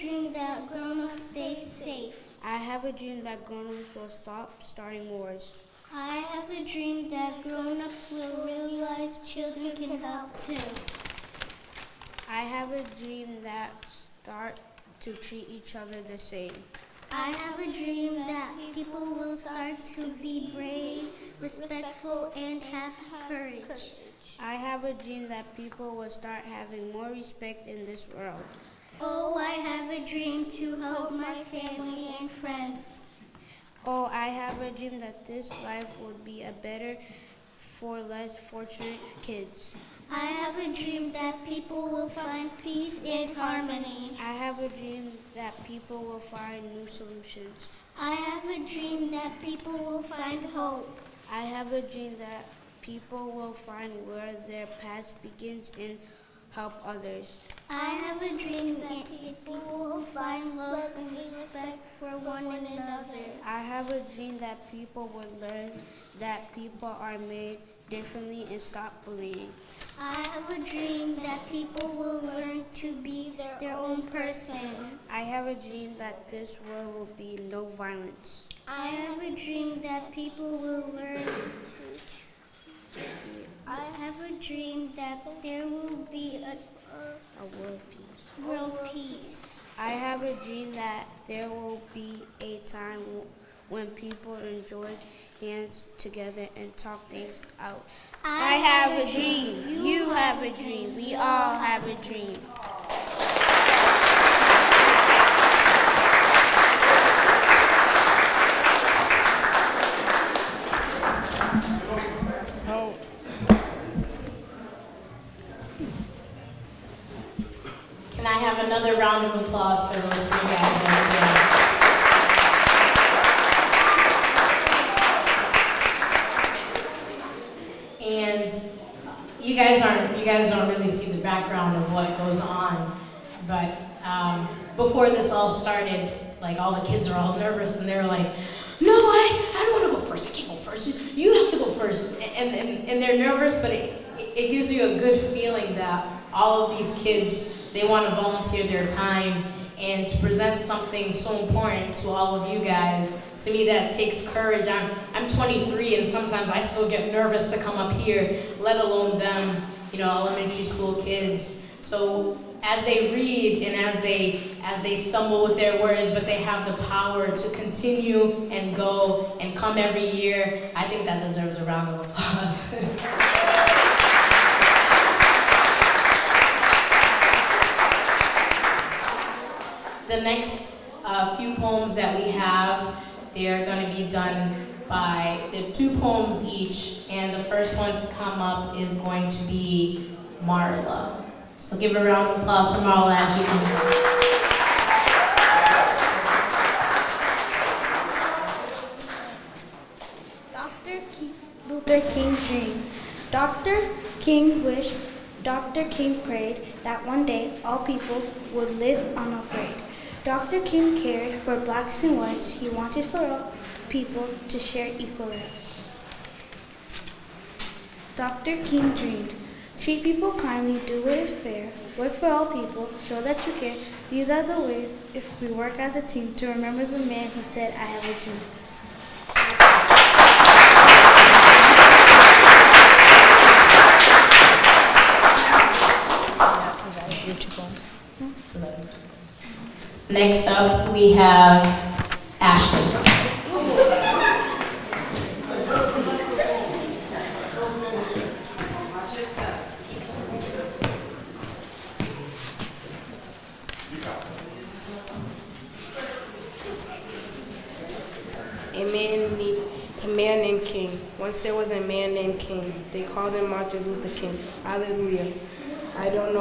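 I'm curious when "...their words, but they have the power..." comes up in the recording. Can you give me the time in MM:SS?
02:45.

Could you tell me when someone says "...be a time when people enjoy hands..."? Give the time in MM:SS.
01:31.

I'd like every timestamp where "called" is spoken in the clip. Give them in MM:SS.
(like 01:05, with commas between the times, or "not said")
04:23.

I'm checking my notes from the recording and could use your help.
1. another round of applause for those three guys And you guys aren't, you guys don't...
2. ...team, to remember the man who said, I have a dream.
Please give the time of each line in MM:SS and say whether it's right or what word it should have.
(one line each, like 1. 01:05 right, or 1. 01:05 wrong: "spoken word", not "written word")
1. 01:58 right
2. 03:46 right.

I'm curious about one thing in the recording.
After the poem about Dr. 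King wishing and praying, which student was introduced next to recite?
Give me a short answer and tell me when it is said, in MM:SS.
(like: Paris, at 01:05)
Ashley, at 04:02.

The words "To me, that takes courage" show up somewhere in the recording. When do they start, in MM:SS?
02:33.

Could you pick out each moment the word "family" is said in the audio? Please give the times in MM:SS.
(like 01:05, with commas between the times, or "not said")
00:31.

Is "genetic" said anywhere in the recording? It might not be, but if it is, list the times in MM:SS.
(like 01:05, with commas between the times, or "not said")
not said.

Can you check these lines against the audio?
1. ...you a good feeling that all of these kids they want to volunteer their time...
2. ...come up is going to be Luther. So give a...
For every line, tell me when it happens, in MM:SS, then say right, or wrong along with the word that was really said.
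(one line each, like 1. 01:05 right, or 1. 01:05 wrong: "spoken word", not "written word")
1. 02:24 right
2. 03:08 wrong: "Marla", not "Luther".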